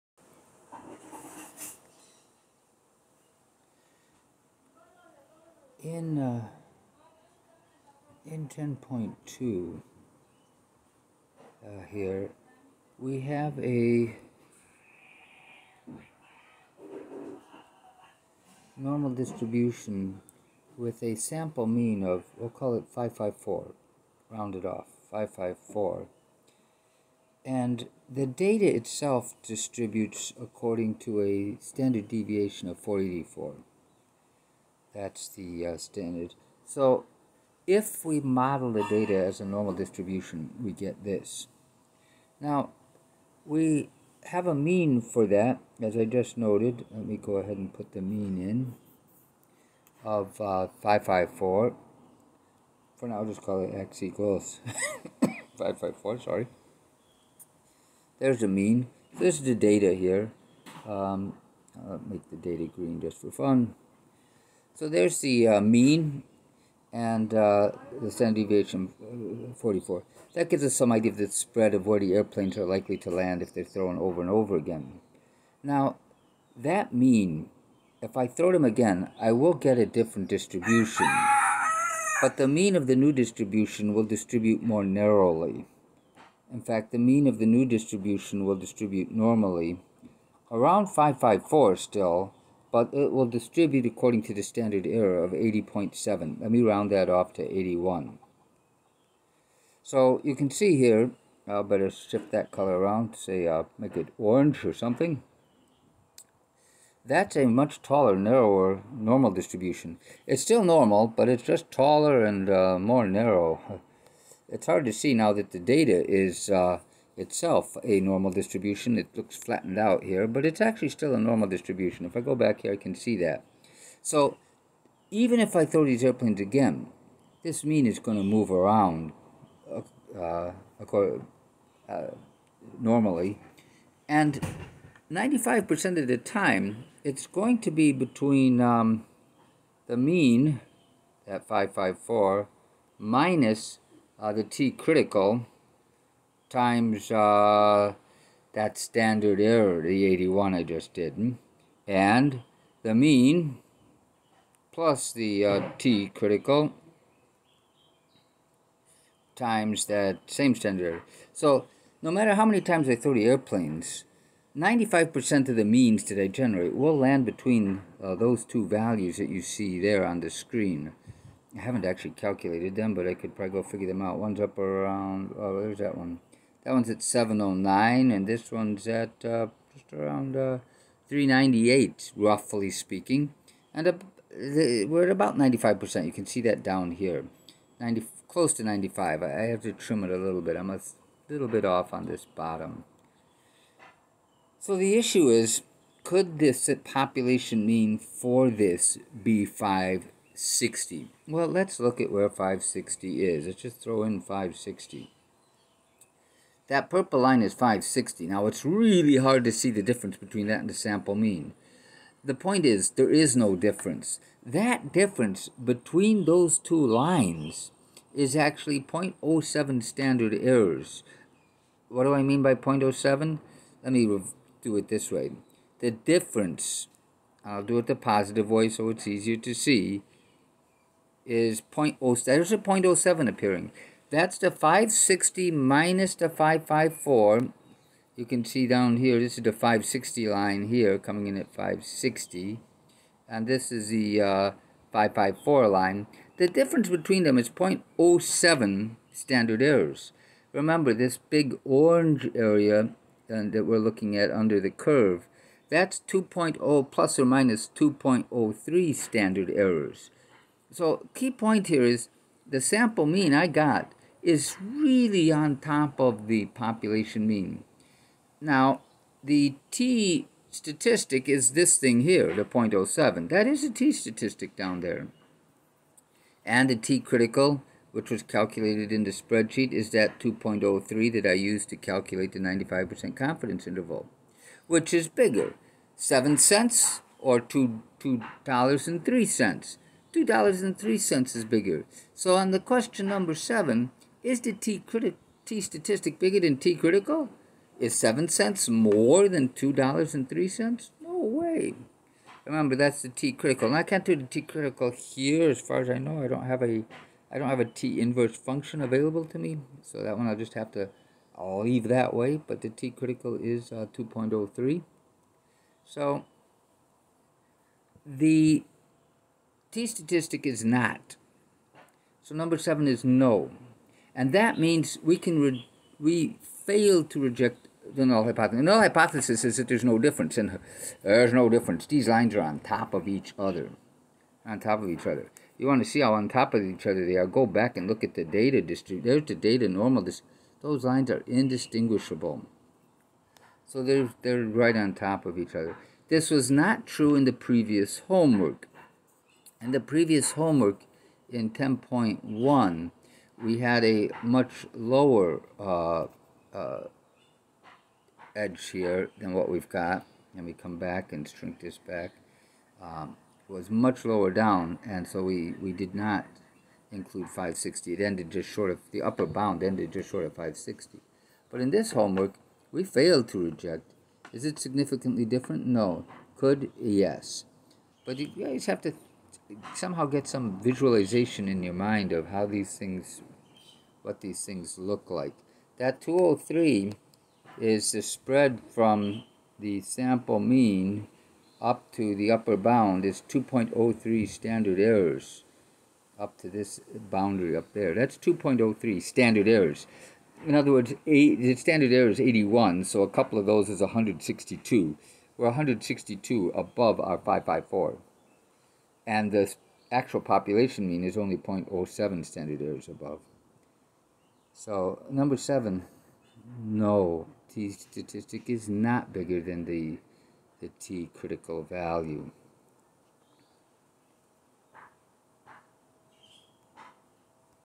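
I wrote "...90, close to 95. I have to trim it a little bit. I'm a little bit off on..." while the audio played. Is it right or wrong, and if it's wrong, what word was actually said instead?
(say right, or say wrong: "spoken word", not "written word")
right.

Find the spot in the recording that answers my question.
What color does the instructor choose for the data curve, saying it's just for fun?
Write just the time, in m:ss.
1:02.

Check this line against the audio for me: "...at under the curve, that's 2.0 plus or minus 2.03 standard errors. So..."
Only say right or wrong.
right.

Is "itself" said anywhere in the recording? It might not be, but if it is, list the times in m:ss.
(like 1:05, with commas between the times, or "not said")
0:28, 1:57.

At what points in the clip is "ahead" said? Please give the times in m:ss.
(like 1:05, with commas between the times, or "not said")
0:47.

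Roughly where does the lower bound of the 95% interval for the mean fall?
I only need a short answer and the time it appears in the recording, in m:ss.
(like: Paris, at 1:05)
398, at 3:01.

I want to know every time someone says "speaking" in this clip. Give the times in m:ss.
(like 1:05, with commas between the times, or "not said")
3:02.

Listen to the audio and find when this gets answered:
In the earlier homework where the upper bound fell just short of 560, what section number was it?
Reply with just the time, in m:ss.
5:51.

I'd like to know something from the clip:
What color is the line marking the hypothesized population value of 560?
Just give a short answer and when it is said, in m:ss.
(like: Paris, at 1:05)
purple, at 3:26.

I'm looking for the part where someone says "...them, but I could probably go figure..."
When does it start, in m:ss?
2:52.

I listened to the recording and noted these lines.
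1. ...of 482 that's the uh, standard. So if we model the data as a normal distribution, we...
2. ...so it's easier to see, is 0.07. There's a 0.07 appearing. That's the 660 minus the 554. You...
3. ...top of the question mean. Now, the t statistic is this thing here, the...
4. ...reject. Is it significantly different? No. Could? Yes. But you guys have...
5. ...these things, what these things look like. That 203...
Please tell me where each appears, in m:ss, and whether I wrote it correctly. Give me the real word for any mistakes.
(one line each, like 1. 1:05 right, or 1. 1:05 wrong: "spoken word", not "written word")
1. 0:32 wrong: "484", not "482"
2. 3:48 wrong: "560", not "660"
3. 4:25 wrong: "population", not "question"
4. 6:13 right
5. 6:22 right.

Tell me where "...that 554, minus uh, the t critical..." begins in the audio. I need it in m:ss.
2:21.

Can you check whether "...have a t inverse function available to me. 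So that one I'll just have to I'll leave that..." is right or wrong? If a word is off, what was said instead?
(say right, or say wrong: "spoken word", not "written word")
right.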